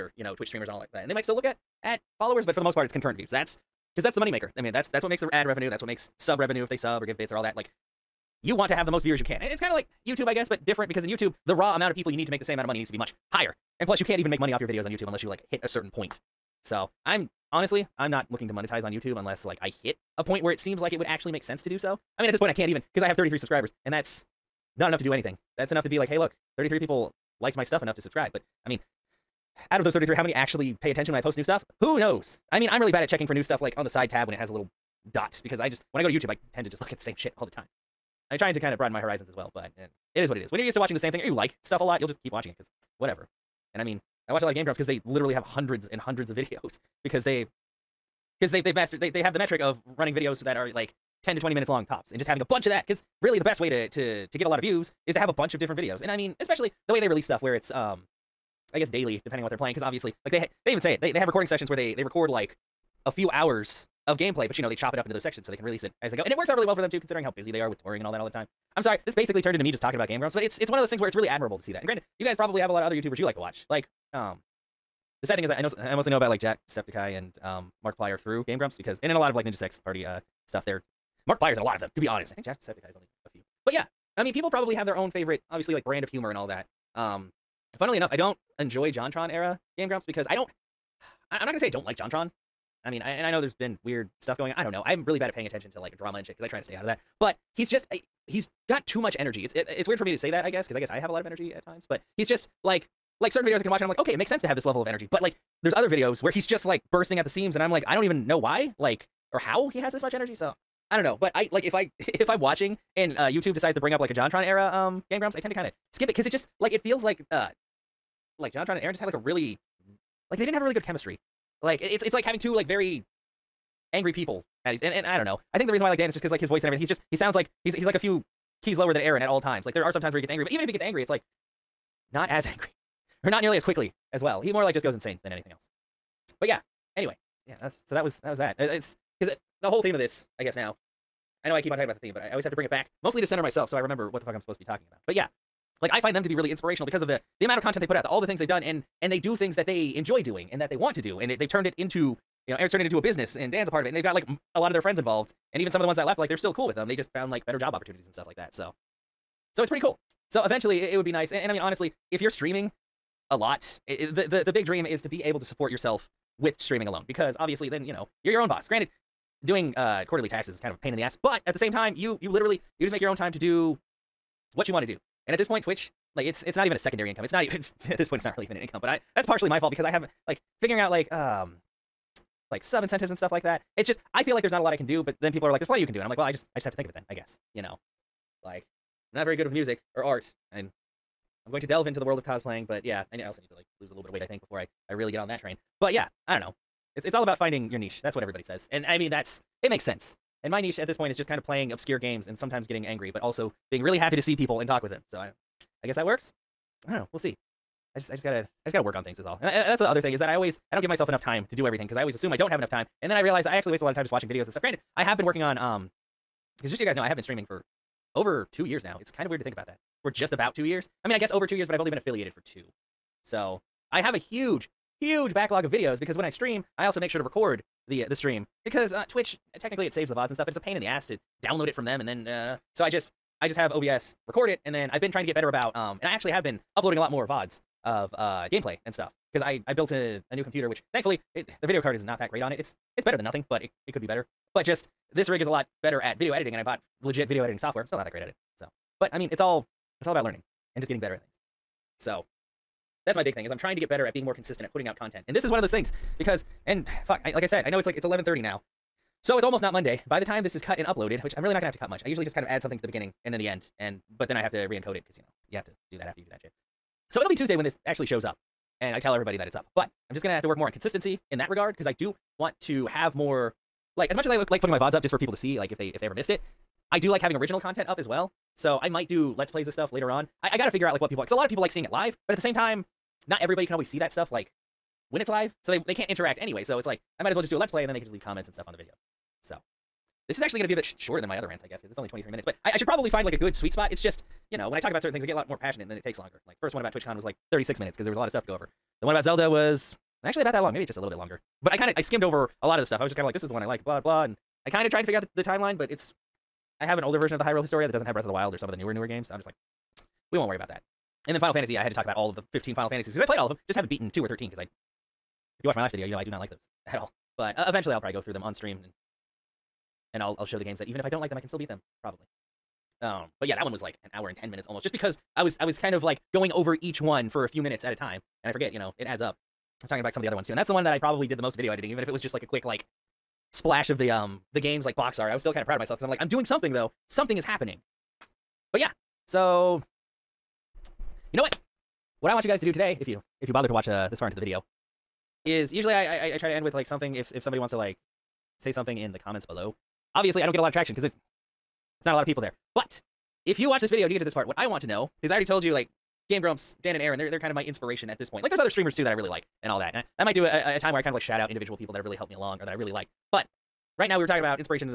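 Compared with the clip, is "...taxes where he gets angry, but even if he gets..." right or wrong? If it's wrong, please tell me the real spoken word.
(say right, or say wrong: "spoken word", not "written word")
wrong: "times", not "taxes".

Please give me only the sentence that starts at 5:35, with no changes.
I was still kind of proud of myself because I'm like, I'm doing something though.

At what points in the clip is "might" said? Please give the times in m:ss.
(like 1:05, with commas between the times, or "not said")
0:01, 4:38, 4:47, 6:00.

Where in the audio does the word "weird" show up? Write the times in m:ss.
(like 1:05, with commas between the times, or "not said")
1:33, 1:39, 3:39.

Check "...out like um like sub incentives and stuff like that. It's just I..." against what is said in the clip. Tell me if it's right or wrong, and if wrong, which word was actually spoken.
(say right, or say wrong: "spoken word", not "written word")
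right.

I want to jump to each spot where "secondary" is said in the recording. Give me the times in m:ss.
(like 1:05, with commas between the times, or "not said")
2:56.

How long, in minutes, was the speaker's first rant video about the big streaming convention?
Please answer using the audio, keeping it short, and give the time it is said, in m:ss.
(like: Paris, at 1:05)
36 minutes, at 4:57.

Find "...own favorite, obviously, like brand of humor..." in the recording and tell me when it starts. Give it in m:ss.
1:24.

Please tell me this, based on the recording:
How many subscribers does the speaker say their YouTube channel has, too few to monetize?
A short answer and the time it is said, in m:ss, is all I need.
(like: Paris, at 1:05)
33, at 0:23.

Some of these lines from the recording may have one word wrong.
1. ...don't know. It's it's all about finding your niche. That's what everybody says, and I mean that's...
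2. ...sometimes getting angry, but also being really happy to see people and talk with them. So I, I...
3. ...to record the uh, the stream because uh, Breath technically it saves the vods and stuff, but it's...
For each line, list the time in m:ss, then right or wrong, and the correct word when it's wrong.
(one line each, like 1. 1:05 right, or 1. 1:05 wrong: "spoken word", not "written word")
1. 3:16 right
2. 3:22 right
3. 3:47 wrong: "Twitch", not "Breath".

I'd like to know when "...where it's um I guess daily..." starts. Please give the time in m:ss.
0:57.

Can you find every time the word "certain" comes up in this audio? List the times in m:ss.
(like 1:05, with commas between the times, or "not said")
0:15, 1:43, 4:55.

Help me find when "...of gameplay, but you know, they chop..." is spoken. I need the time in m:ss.
1:04.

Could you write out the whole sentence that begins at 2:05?
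I think the reason why I like Dan is just because like his voice and everything.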